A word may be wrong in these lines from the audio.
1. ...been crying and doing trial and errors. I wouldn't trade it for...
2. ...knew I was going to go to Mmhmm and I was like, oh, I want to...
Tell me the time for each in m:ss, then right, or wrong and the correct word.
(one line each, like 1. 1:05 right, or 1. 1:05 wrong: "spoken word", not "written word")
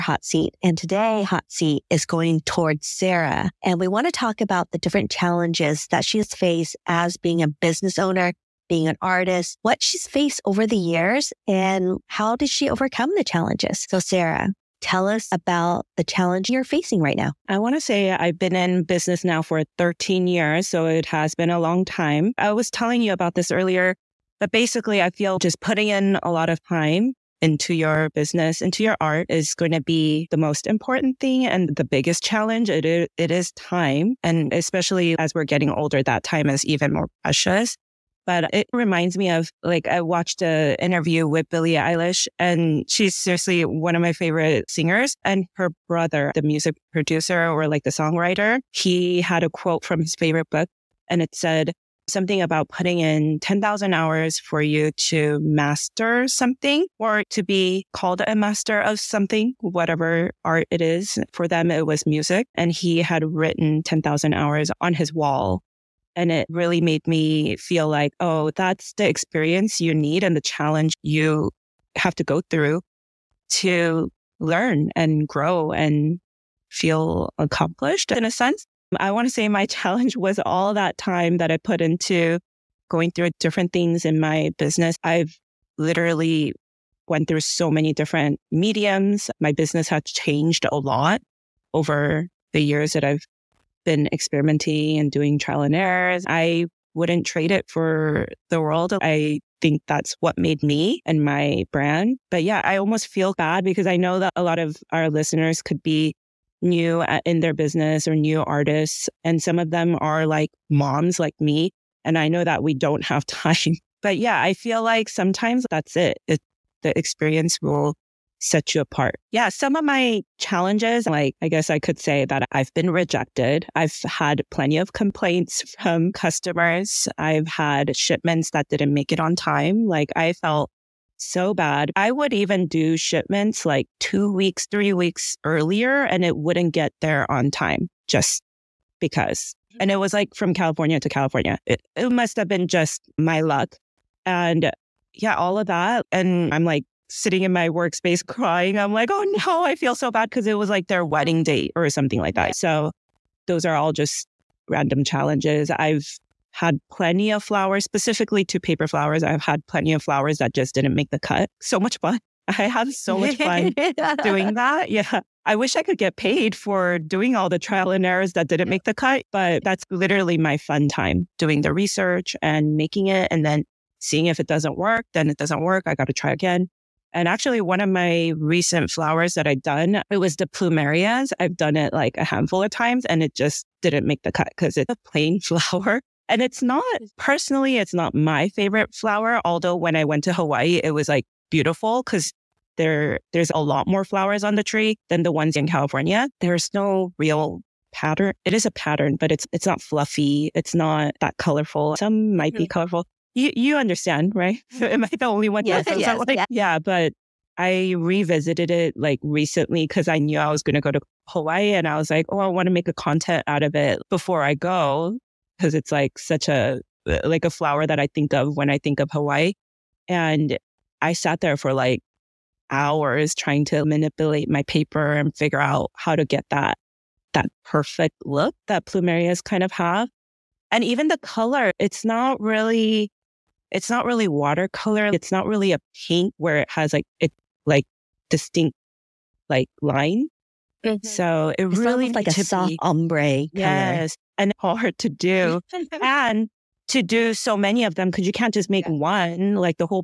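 1. 1:33 wrong: "experimenting", not "crying"
2. 3:30 wrong: "Hawaii", not "Mmhmm".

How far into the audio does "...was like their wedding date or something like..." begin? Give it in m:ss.
2:30.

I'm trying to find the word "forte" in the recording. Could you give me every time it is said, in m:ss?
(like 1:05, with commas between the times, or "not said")
not said.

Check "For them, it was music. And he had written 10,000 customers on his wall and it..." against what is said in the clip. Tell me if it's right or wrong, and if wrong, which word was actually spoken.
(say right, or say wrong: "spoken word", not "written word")
wrong: "hours", not "customers".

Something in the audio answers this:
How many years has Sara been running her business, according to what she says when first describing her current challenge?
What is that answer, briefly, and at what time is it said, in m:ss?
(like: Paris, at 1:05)
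13, at 0:19.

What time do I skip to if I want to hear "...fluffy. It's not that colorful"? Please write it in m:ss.
3:19.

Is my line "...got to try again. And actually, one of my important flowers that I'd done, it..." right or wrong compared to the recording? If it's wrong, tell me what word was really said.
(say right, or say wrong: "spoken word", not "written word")
wrong: "recent", not "important".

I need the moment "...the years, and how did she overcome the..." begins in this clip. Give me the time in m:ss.
0:10.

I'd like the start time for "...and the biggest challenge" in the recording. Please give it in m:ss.
0:31.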